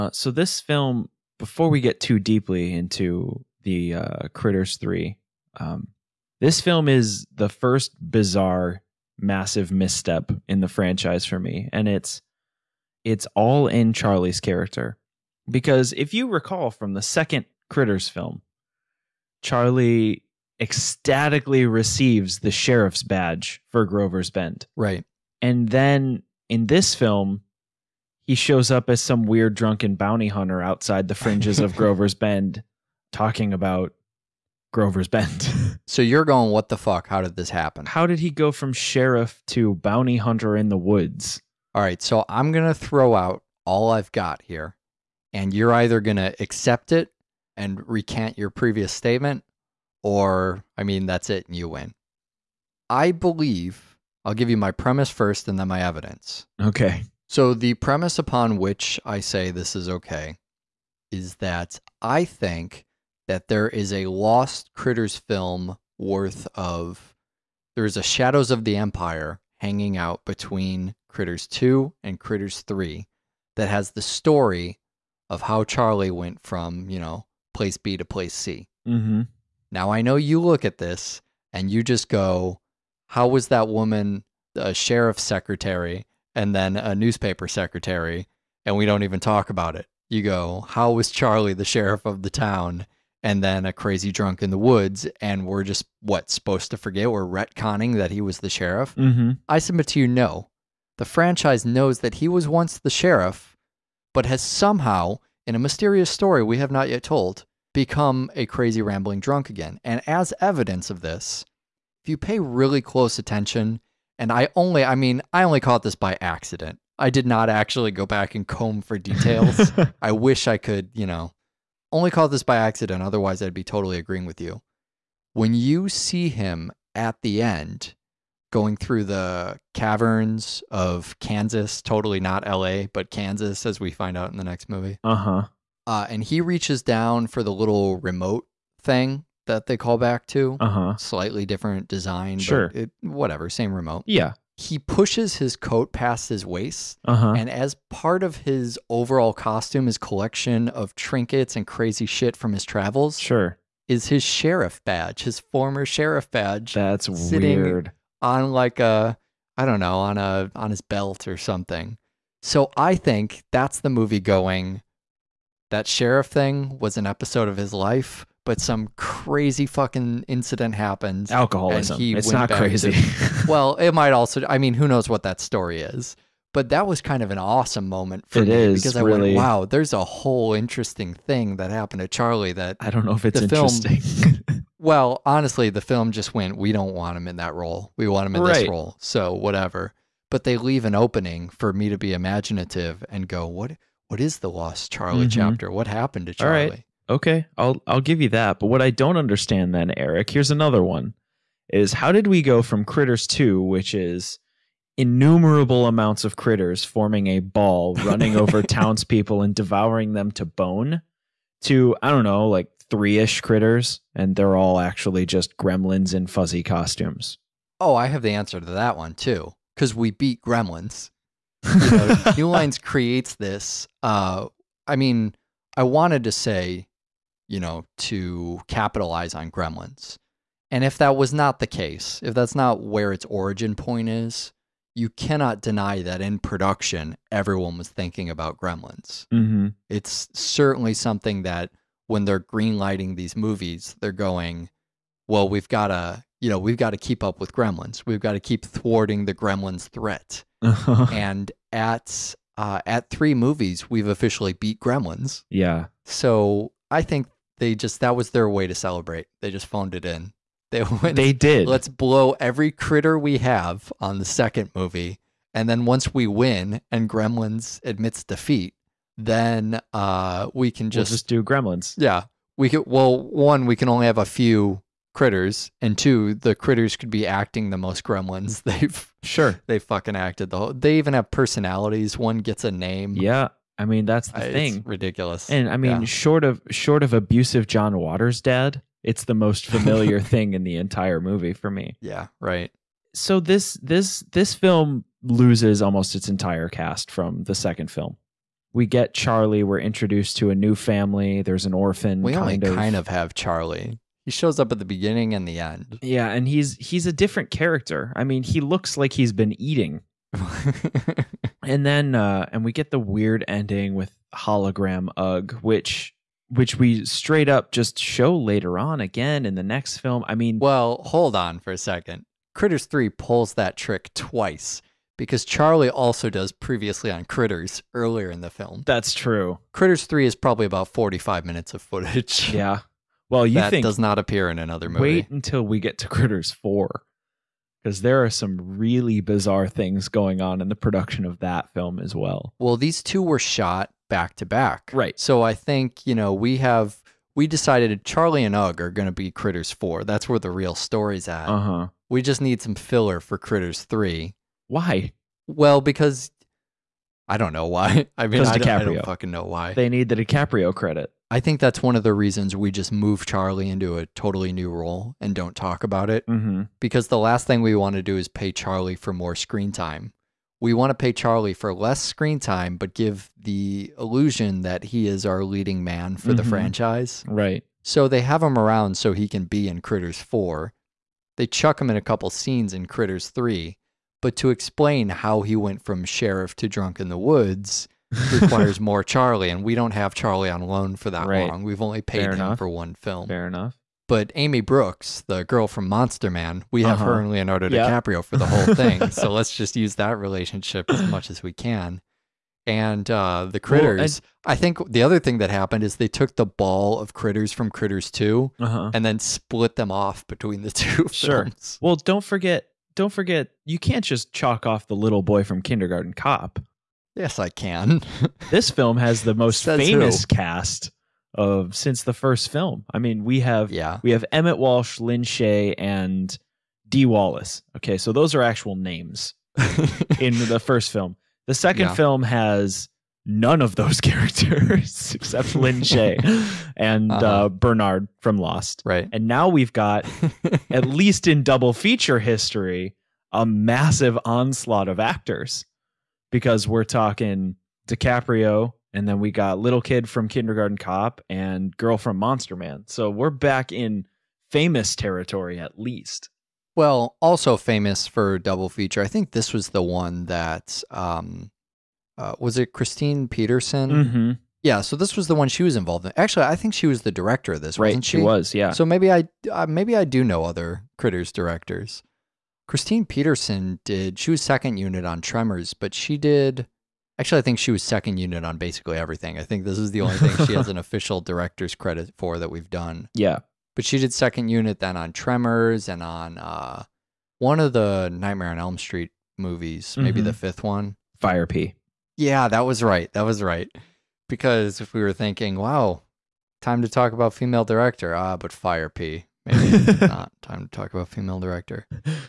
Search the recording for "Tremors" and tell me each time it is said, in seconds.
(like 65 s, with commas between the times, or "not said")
475 s, 485 s.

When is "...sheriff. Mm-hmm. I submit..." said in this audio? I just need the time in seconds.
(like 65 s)
98 s.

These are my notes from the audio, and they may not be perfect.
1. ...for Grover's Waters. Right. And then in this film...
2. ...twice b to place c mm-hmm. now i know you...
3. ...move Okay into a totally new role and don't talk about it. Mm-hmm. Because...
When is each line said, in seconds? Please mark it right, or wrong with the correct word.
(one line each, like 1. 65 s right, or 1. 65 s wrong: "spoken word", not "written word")
1. 23 s wrong: "Bend", not "Waters"
2. 77 s wrong: "place", not "twice"
3. 362 s wrong: "Charlie", not "Okay".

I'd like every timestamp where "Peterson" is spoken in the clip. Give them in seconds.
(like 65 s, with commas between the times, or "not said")
463 s, 473 s.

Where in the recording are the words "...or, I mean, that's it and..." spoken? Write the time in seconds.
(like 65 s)
50 s.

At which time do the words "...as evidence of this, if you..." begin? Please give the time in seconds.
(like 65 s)
110 s.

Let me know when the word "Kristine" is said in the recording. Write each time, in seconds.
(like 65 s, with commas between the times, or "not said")
462 s, 472 s.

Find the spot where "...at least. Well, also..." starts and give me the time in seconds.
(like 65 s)
455 s.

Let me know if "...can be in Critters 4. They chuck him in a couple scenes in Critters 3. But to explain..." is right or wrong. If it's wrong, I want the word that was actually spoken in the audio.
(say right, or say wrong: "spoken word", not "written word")
right.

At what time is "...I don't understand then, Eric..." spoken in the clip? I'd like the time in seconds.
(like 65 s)
198 s.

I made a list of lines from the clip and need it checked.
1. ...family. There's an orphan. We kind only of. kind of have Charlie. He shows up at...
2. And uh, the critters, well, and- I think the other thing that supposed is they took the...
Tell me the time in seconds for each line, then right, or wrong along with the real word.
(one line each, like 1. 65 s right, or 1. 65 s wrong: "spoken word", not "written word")
1. 300 s right
2. 402 s wrong: "happened", not "supposed".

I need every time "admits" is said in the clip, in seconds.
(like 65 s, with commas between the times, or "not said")
267 s.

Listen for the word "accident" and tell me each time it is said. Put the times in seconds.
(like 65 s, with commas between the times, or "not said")
116 s, 122 s.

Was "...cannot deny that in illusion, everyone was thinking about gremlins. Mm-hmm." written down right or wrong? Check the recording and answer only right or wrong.
wrong.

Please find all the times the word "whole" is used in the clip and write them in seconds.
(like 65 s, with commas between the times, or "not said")
180 s, 280 s, 398 s.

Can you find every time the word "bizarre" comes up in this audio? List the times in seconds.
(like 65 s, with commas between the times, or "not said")
7 s, 339 s.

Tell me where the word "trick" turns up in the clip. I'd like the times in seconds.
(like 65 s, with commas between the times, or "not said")
323 s.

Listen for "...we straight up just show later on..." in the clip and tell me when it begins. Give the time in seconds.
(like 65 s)
316 s.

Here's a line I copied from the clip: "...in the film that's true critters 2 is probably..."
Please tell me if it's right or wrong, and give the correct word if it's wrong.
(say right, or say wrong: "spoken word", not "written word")
wrong: "3", not "2".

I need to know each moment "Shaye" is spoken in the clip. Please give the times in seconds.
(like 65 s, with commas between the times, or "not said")
425 s, 435 s.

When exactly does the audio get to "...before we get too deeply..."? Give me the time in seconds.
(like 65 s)
1 s.